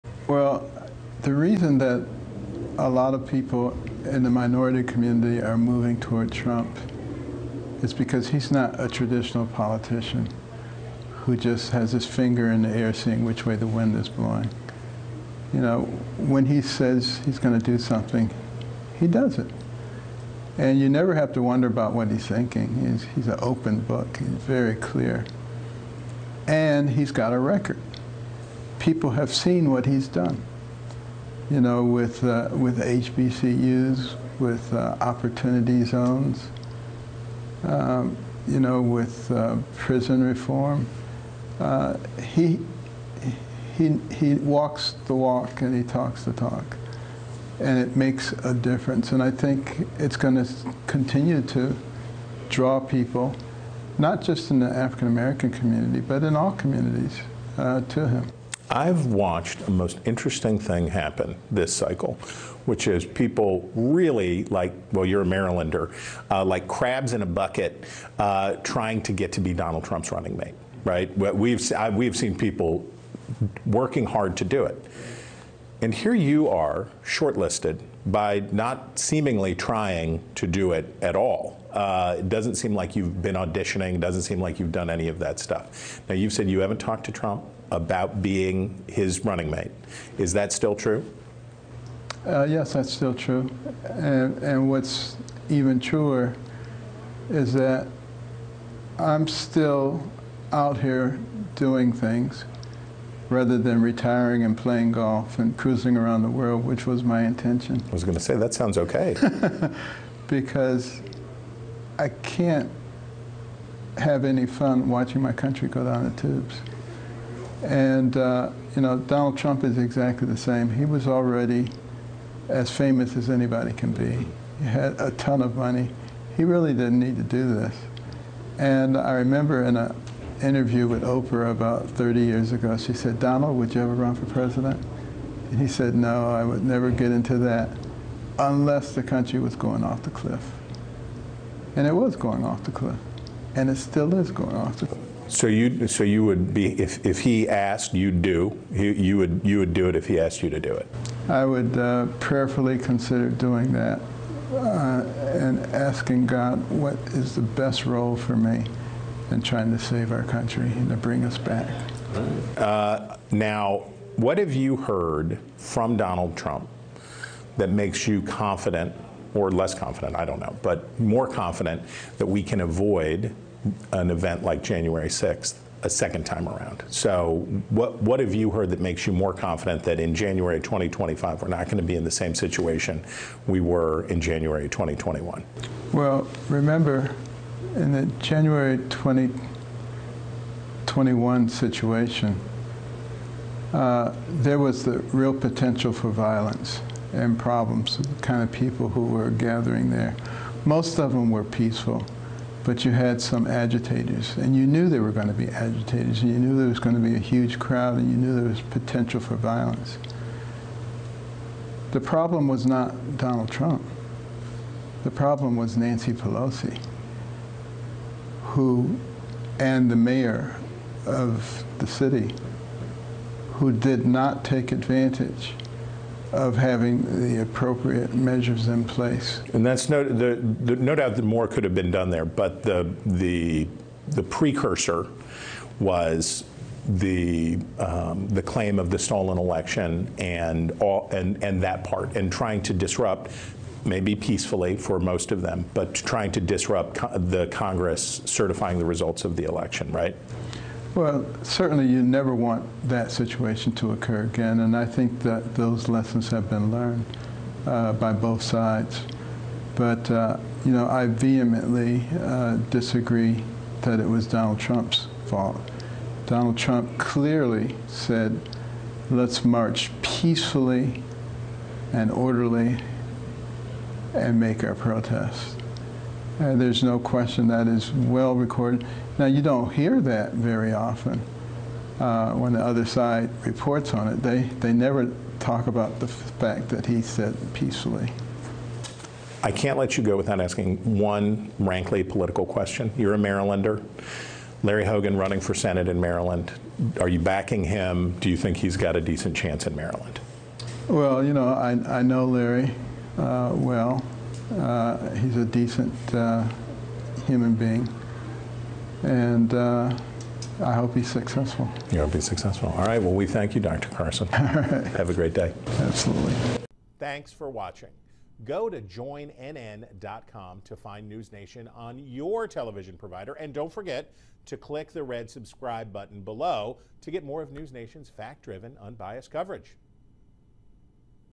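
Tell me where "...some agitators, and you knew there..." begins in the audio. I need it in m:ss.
3:23.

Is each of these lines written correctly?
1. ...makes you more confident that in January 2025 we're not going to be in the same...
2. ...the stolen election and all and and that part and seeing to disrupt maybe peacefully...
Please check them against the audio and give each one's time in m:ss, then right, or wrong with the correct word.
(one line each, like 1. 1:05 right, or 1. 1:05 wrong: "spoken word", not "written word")
1. 2:58 right
2. 3:58 wrong: "trying", not "seeing".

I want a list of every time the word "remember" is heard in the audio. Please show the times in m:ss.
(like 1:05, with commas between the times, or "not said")
2:09, 3:06.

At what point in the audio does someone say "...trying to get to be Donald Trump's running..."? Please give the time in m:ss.
1:08.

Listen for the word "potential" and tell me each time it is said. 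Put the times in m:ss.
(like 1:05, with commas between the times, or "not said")
3:15, 3:28.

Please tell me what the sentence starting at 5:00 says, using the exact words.
Well, you know, I, I know Larry uh, well.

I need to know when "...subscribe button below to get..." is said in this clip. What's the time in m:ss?
5:25.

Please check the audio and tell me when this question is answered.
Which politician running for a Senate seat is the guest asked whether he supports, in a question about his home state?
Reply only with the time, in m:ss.
4:54.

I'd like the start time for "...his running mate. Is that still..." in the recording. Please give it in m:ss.
1:28.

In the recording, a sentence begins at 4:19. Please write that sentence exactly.
But, uh, you know, I vehemently uh, disagree that it was Donald Trump's fault.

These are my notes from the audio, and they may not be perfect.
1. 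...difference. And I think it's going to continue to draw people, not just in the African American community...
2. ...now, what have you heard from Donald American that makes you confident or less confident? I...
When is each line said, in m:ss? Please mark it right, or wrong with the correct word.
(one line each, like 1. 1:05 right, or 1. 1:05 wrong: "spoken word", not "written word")
1. 0:48 right
2. 2:43 wrong: "Trump", not "American".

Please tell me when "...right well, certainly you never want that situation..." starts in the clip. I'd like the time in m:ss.
4:09.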